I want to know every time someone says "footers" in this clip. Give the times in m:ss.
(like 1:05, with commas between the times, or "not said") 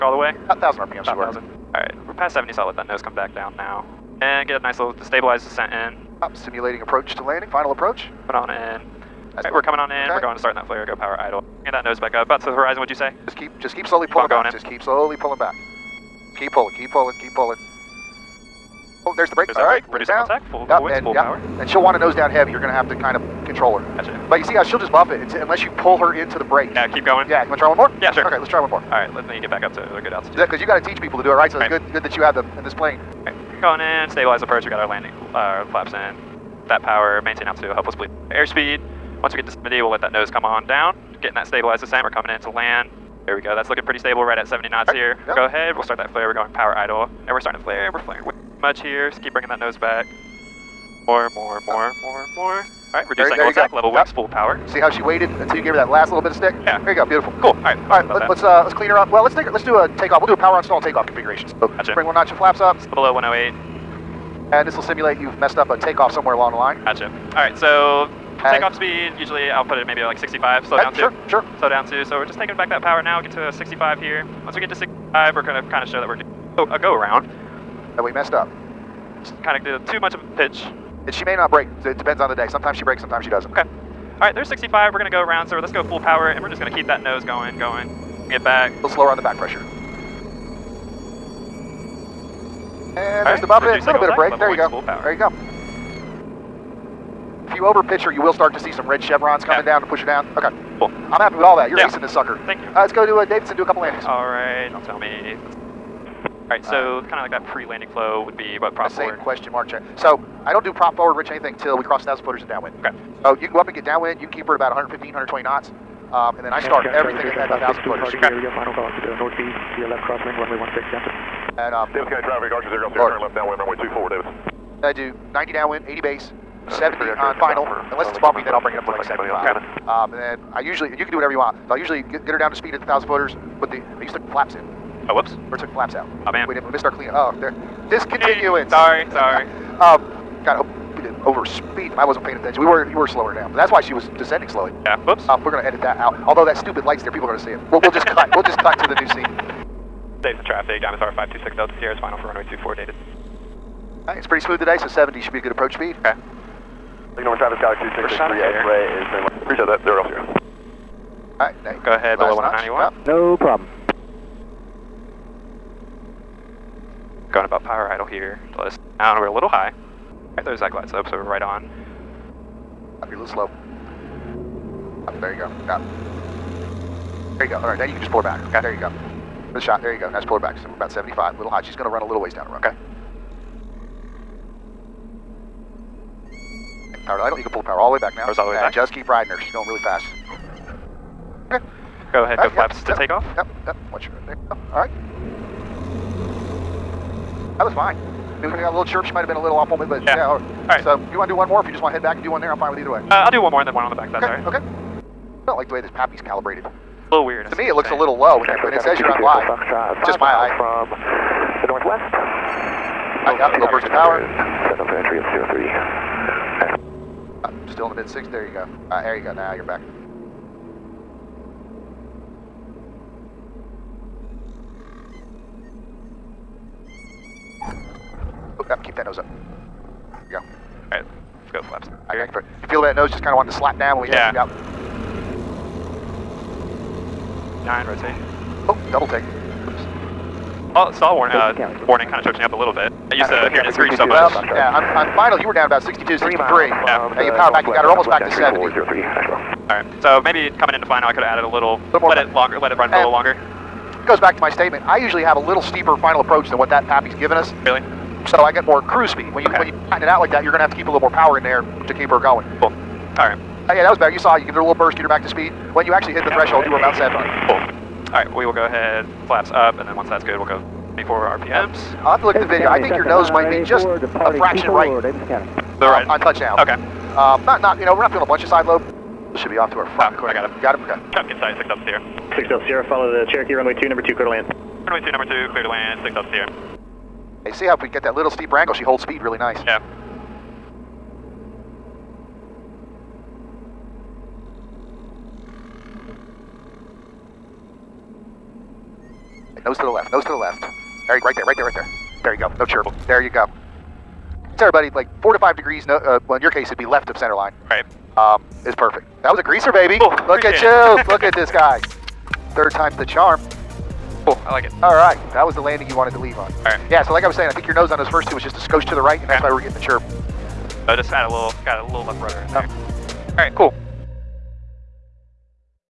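1:52, 1:57, 2:13.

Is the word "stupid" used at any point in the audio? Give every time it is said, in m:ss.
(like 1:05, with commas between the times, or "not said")
2:26.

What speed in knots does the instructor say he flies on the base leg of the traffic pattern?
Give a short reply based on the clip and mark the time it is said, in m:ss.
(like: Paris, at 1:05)
80, at 2:05.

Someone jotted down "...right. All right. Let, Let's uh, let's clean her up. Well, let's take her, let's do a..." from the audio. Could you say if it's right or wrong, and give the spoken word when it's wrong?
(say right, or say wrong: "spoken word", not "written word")
right.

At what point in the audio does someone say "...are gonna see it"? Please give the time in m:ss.
2:27.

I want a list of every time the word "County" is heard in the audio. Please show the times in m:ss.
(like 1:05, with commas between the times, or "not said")
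2:02.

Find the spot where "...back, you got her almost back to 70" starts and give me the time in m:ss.
4:07.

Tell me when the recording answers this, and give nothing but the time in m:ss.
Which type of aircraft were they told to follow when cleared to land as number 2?
4:43.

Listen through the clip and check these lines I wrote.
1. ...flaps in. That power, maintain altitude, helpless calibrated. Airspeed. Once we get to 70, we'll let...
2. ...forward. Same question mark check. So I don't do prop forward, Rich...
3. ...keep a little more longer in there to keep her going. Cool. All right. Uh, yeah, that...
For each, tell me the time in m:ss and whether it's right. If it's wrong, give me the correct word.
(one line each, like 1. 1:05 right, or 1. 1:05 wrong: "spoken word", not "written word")
1. 0:35 wrong: "bleed", not "calibrated"
2. 1:48 right
3. 4:20 wrong: "power", not "longer".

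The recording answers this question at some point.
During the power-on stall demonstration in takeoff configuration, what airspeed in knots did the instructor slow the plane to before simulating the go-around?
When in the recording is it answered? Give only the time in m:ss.
1:13.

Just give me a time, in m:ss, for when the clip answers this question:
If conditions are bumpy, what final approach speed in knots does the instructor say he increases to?
2:08.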